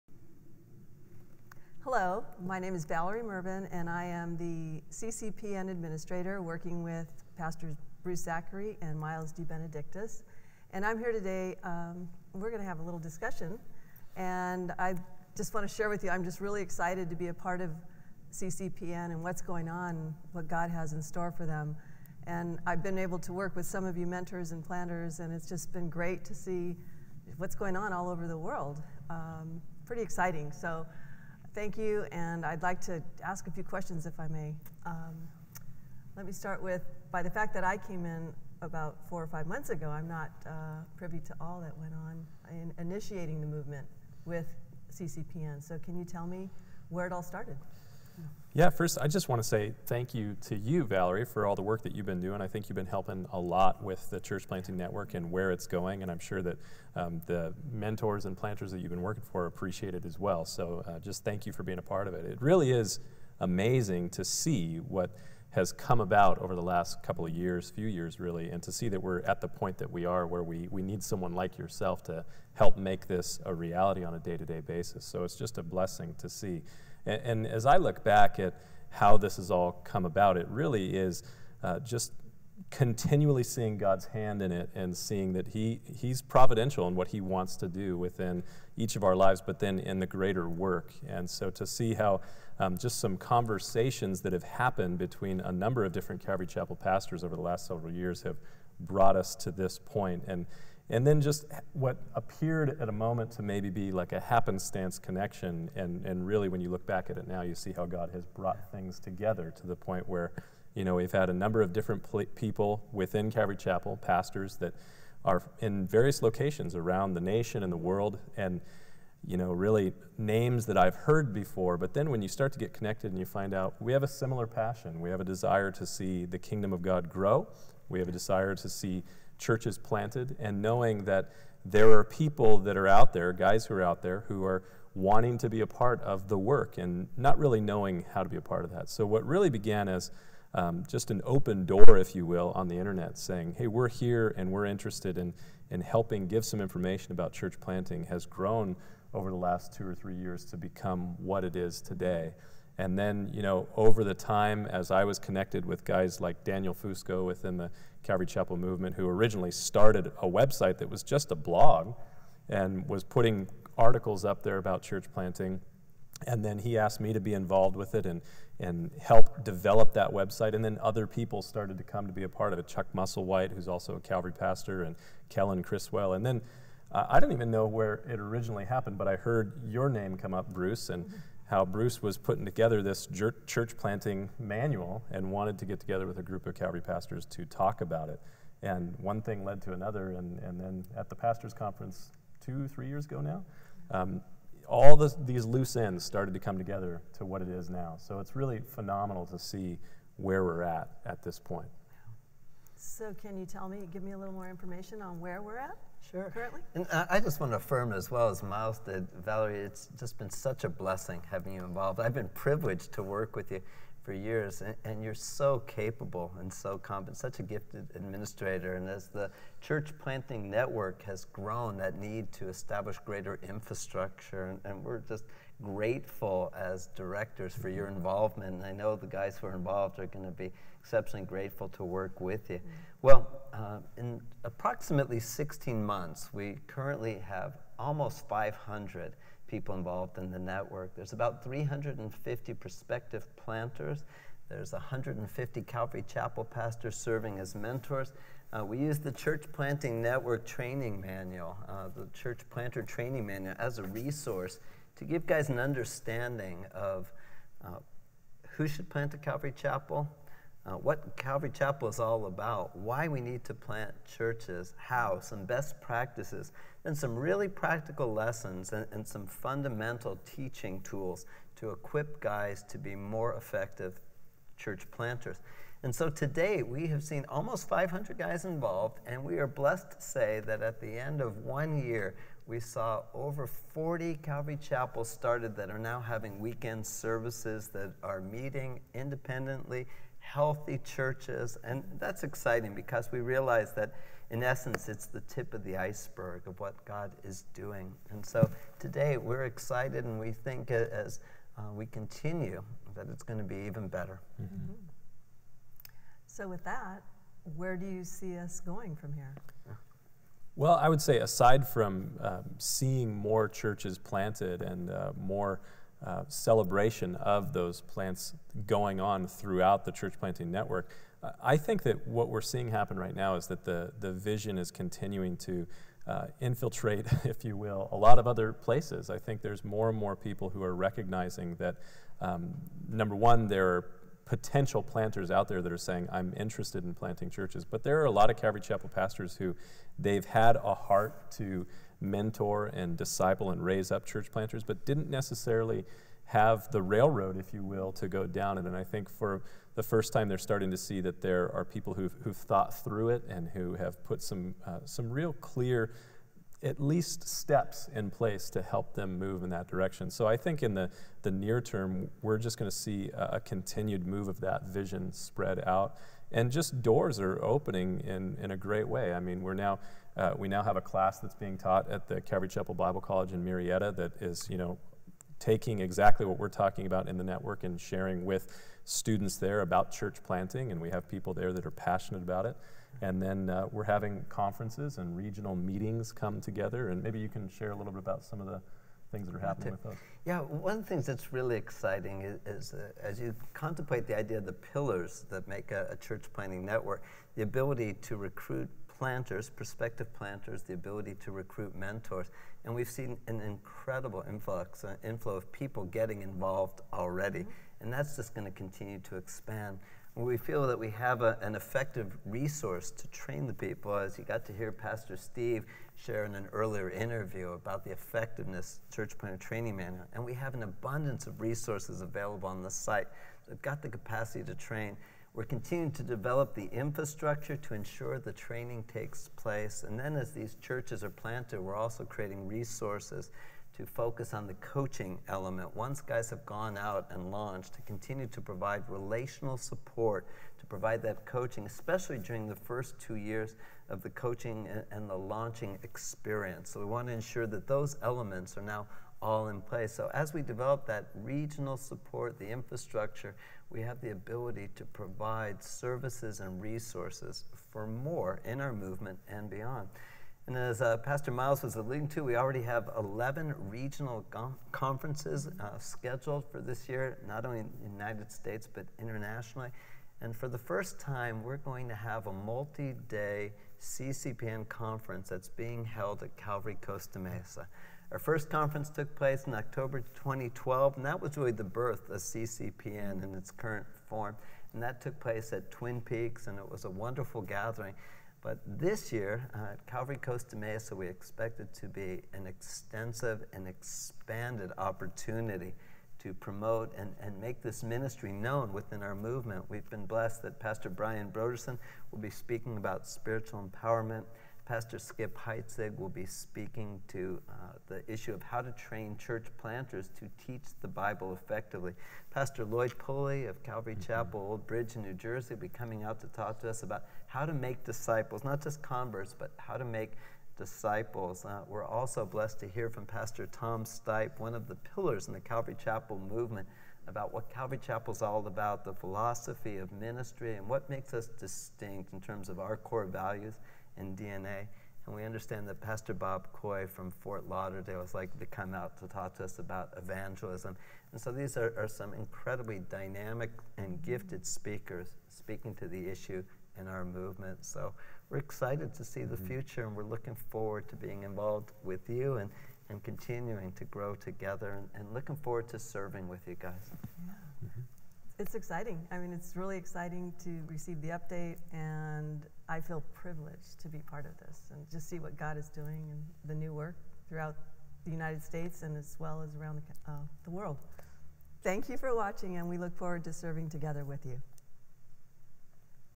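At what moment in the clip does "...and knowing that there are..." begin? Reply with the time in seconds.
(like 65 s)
130 s.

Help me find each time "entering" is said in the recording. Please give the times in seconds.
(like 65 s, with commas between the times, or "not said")
not said.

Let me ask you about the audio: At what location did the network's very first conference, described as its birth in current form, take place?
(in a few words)
Twin Peaks.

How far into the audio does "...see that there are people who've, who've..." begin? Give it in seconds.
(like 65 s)
350 s.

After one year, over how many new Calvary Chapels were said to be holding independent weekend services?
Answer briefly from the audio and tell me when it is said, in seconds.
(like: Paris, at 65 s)
40, at 283 s.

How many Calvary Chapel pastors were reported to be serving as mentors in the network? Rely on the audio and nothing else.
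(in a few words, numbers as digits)
150.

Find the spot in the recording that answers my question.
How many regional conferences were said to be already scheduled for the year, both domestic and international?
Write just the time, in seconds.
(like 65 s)
462 s.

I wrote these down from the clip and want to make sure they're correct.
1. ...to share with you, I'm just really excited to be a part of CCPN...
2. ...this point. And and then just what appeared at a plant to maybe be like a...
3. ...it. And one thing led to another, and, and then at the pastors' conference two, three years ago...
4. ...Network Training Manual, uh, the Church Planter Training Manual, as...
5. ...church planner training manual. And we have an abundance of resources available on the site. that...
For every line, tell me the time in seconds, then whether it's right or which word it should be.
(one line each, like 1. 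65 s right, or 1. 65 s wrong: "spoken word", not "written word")
1. 15 s right
2. 99 s wrong: "moment", not "plant"
3. 188 s right
4. 249 s right
5. 418 s right.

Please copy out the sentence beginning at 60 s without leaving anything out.
So uh, just thank you for being a part of it.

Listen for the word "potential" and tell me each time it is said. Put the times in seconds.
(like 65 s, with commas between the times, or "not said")
334 s.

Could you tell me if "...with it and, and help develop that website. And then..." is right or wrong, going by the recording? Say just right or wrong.
right.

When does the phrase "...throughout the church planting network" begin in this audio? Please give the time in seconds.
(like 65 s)
319 s.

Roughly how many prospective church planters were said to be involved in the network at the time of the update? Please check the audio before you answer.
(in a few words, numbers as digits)
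350.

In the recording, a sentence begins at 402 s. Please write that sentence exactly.
And we've seen an incredible influx, uh, inflow of people getting involved already.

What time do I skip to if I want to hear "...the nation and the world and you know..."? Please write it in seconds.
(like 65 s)
117 s.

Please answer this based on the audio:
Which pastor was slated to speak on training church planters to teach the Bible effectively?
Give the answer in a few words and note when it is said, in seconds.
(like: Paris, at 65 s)
Skip Heitzig, at 504 s.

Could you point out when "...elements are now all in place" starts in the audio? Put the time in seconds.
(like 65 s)
448 s.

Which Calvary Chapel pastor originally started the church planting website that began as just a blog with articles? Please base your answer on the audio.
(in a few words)
Daniel Fusco.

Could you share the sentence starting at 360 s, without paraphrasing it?
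So I think in the, the near term, we're just going to see a, a continued move of that vision spread out.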